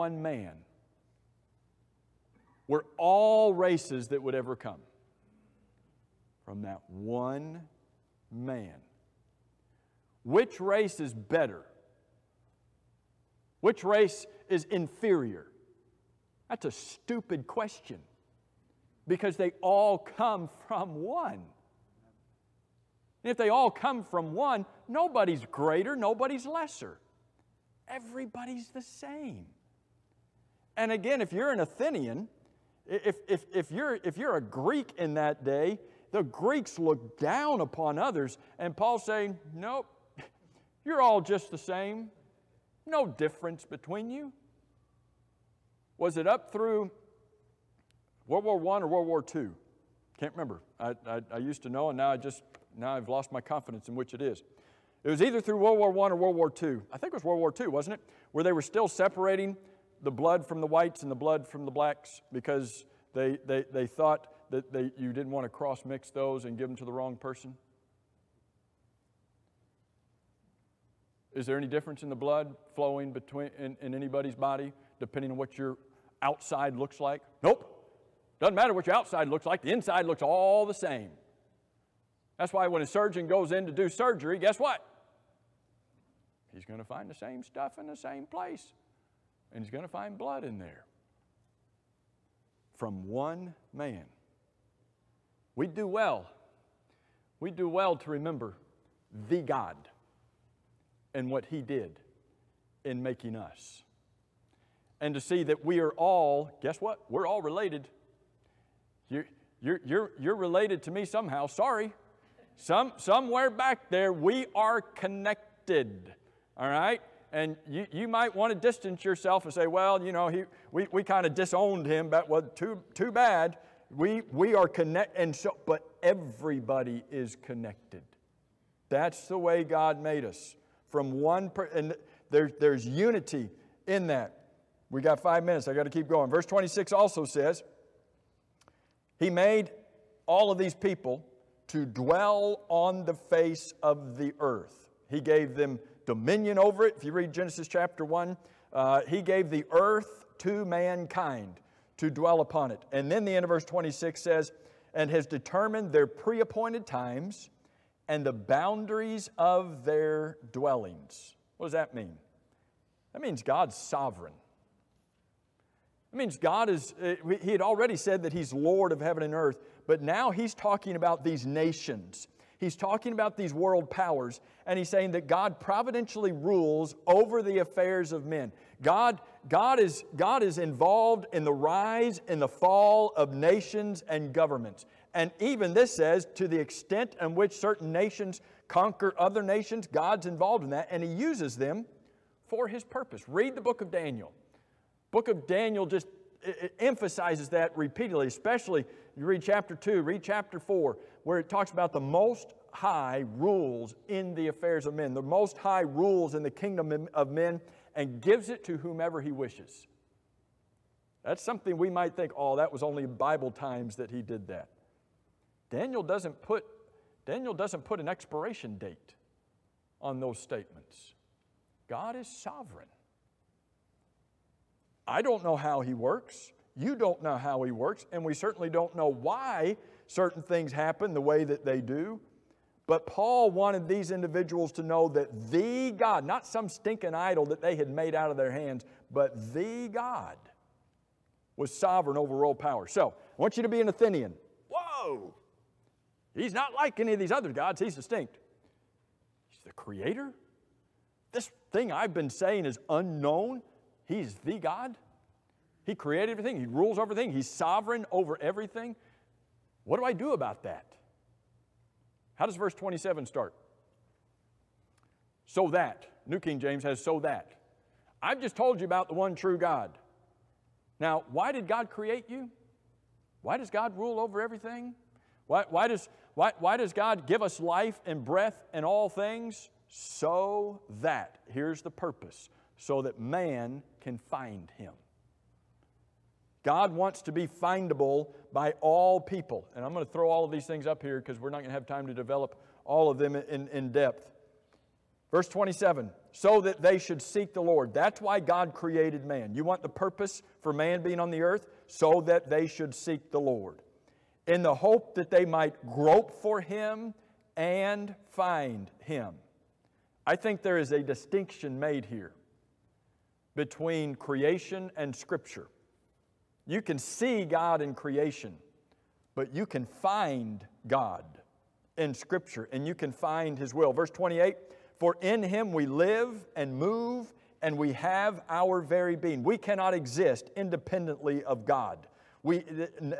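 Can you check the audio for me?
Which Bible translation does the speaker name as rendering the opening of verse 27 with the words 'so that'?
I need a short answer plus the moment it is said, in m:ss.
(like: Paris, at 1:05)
New King James, at 4:26.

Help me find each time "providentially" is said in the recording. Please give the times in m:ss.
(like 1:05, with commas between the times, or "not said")
2:55.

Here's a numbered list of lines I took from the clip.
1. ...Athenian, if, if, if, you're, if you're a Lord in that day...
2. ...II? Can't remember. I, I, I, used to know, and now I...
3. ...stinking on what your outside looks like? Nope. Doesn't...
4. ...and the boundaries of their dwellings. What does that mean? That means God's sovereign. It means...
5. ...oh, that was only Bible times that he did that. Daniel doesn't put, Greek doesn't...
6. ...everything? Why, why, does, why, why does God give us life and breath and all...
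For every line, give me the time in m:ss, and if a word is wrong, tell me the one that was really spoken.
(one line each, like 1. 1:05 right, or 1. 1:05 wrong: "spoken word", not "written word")
1. 0:31 wrong: "Greek", not "Lord"
2. 0:49 right
3. 1:15 wrong: "depending", not "stinking"
4. 2:38 right
5. 3:32 wrong: "Daniel", not "Greek"
6. 4:34 right.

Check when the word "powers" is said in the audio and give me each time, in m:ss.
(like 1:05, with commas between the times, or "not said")
2:53, 4:02.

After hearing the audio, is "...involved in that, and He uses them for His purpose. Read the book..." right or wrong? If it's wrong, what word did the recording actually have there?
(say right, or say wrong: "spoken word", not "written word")
right.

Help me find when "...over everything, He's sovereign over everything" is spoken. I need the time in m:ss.
4:16.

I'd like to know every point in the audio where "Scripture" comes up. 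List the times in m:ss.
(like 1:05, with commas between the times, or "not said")
5:15, 5:22.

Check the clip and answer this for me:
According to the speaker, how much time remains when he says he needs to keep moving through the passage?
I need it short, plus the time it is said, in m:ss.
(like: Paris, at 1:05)
5 minutes, at 2:15.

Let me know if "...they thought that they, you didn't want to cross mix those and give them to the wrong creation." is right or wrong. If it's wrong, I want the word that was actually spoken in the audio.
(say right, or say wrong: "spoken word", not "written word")
wrong: "person", not "creation".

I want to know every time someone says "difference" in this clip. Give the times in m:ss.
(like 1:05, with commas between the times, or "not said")
0:43, 1:11.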